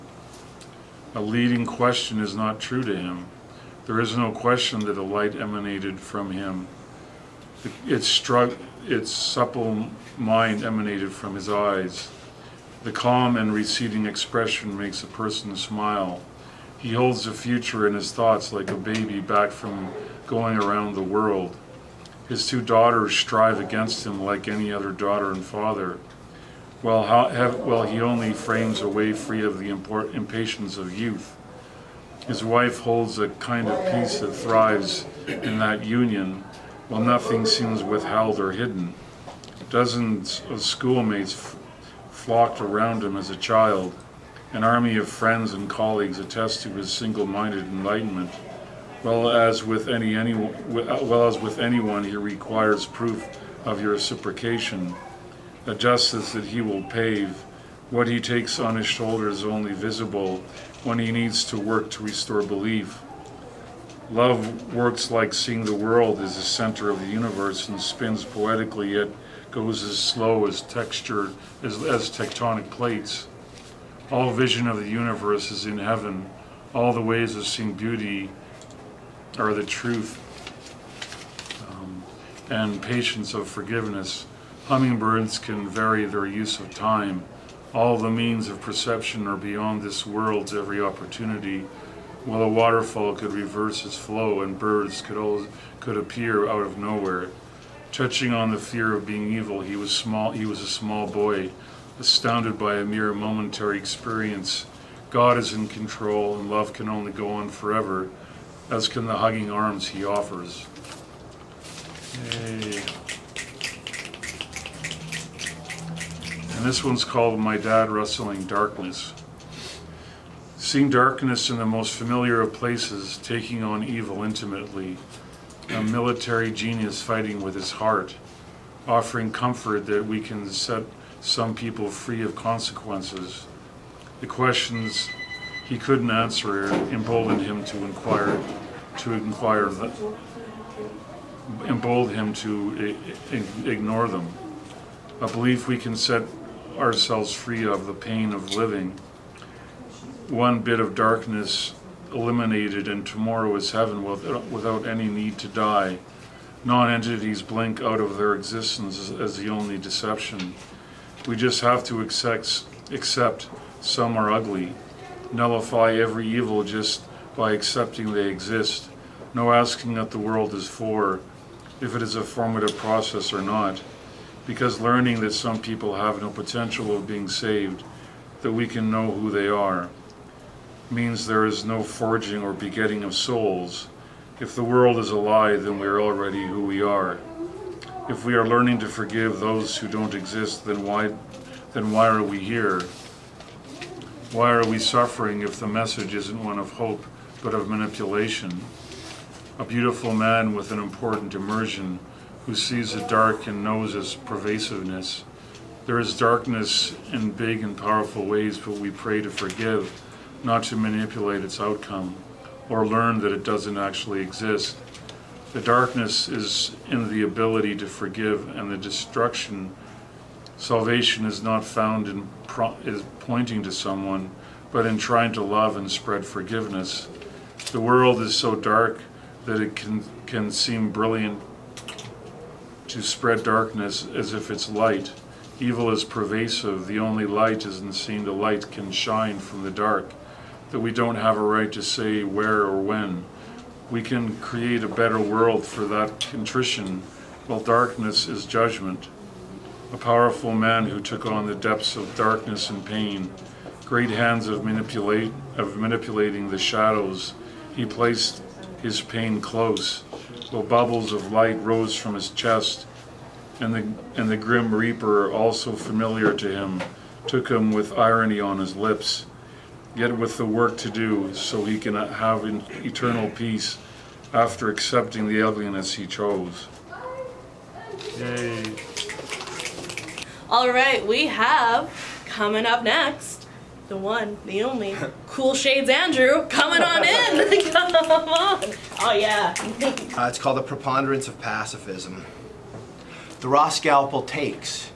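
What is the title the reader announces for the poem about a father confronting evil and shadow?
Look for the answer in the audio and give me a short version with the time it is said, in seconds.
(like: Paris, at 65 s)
My Dad Wrestling Darkness, at 117 s.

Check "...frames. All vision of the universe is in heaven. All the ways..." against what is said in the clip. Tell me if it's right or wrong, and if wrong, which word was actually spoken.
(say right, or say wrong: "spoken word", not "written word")
wrong: "plates", not "frames".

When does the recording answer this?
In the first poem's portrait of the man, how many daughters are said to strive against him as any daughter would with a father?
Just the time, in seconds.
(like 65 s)
22 s.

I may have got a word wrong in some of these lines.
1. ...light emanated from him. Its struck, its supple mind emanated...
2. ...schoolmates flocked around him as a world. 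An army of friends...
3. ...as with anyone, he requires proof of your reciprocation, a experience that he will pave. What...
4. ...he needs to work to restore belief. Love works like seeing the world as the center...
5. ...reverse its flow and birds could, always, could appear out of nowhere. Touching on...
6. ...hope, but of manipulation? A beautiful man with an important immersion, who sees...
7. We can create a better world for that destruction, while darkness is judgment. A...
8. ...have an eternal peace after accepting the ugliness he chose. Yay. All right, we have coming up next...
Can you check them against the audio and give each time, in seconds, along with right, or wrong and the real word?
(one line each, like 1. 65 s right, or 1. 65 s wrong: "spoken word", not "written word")
1. 5 s right
2. 40 s wrong: "child", not "world"
3. 51 s wrong: "justice", not "experience"
4. 60 s right
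5. 93 s right
6. 196 s right
7. 243 s wrong: "contrition", not "destruction"
8. 271 s right.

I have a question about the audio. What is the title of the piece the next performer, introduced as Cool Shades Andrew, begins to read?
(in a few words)
The Preponderance of Pacifism.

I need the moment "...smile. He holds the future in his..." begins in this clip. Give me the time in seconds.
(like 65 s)
15 s.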